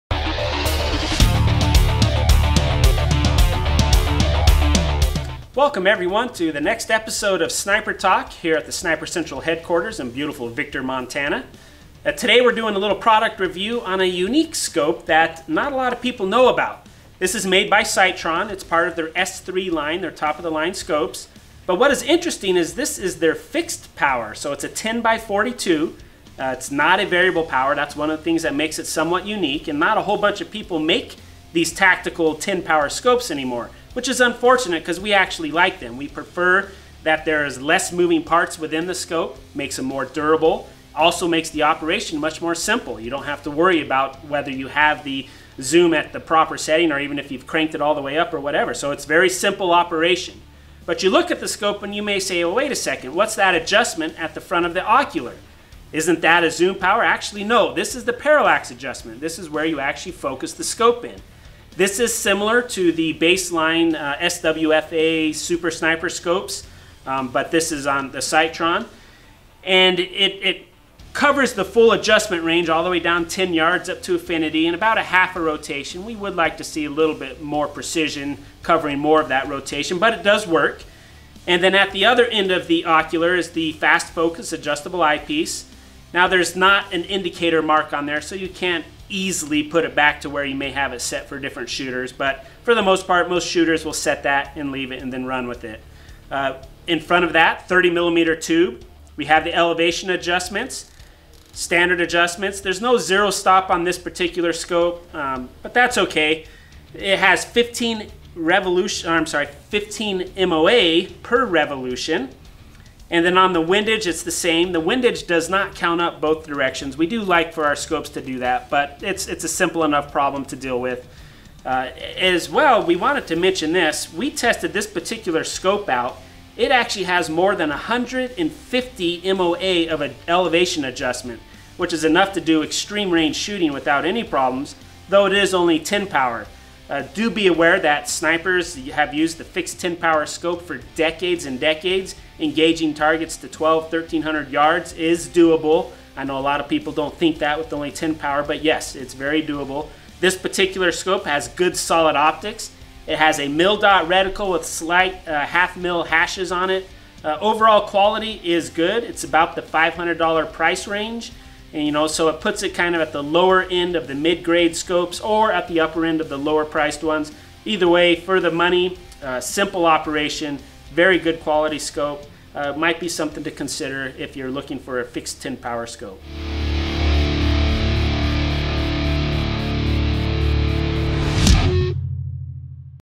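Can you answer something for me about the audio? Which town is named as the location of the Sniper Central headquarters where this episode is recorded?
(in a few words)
Victor, Montana.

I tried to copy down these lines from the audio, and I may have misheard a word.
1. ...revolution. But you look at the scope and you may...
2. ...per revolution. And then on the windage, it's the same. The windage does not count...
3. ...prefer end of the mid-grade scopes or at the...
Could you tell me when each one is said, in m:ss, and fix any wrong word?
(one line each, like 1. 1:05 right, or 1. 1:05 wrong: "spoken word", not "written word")
1. 0:49 wrong: "operation", not "revolution"
2. 1:51 right
3. 2:43 wrong: "lower", not "prefer".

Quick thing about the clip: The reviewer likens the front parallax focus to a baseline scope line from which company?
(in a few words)
SWFA.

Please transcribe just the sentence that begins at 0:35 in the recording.
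We prefer that there is less moving parts within the scope, makes them more durable, also makes the operation much more simple.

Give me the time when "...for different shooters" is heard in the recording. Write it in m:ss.
1:31.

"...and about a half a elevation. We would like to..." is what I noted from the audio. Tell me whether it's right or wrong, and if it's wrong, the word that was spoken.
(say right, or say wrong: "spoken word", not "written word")
wrong: "rotation", not "elevation".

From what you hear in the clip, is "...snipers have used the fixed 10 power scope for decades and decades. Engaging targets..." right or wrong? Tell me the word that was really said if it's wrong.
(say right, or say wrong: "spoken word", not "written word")
right.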